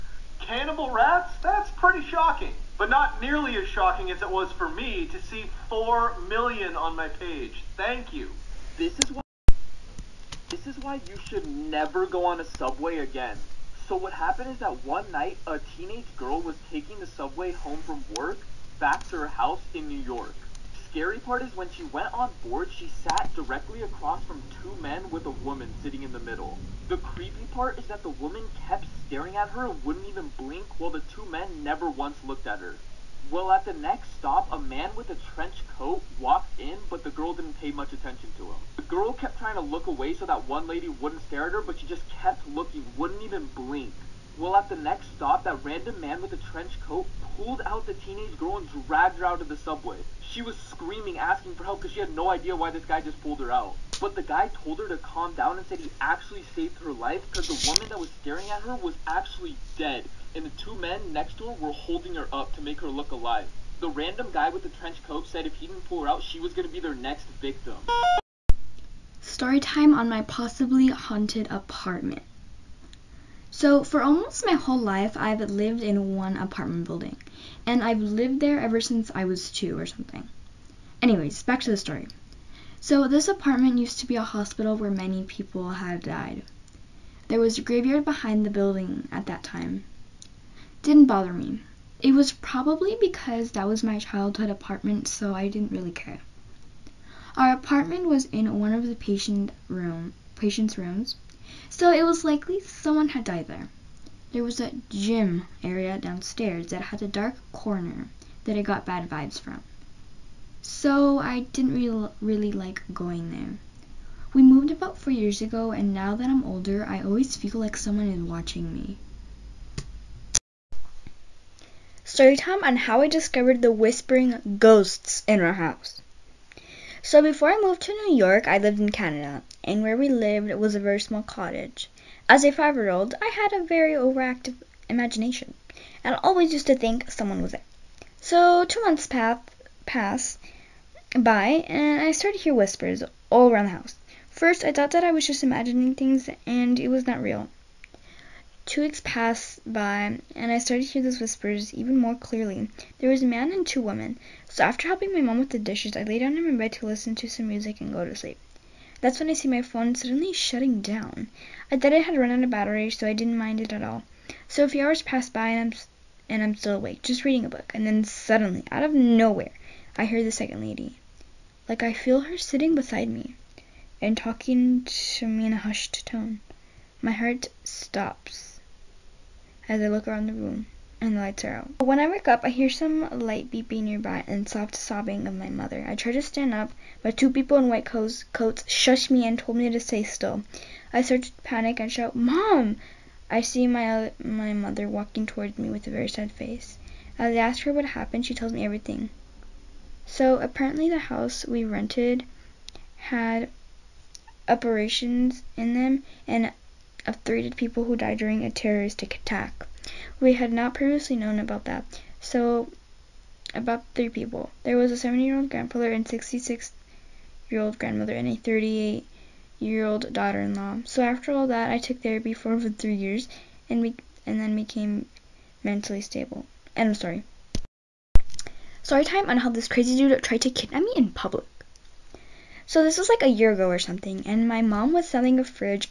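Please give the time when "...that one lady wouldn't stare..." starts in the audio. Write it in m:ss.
0:40.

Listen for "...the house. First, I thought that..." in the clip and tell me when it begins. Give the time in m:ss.
2:23.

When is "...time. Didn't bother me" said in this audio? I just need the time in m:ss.
1:29.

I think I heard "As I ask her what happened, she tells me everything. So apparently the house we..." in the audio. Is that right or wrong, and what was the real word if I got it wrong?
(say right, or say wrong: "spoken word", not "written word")
right.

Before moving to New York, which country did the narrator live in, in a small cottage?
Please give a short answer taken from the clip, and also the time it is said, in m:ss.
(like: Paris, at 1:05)
Canada, at 2:08.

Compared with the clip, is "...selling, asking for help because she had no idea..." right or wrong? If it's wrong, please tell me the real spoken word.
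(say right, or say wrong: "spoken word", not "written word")
wrong: "screaming", not "selling".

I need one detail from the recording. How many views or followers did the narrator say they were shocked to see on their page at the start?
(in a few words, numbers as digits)
4 million.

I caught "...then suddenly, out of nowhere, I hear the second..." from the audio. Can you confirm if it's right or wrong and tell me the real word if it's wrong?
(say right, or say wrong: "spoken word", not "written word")
right.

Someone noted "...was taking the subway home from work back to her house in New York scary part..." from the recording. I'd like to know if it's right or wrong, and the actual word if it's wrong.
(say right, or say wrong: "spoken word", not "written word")
right.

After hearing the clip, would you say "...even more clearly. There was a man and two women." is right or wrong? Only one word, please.
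right.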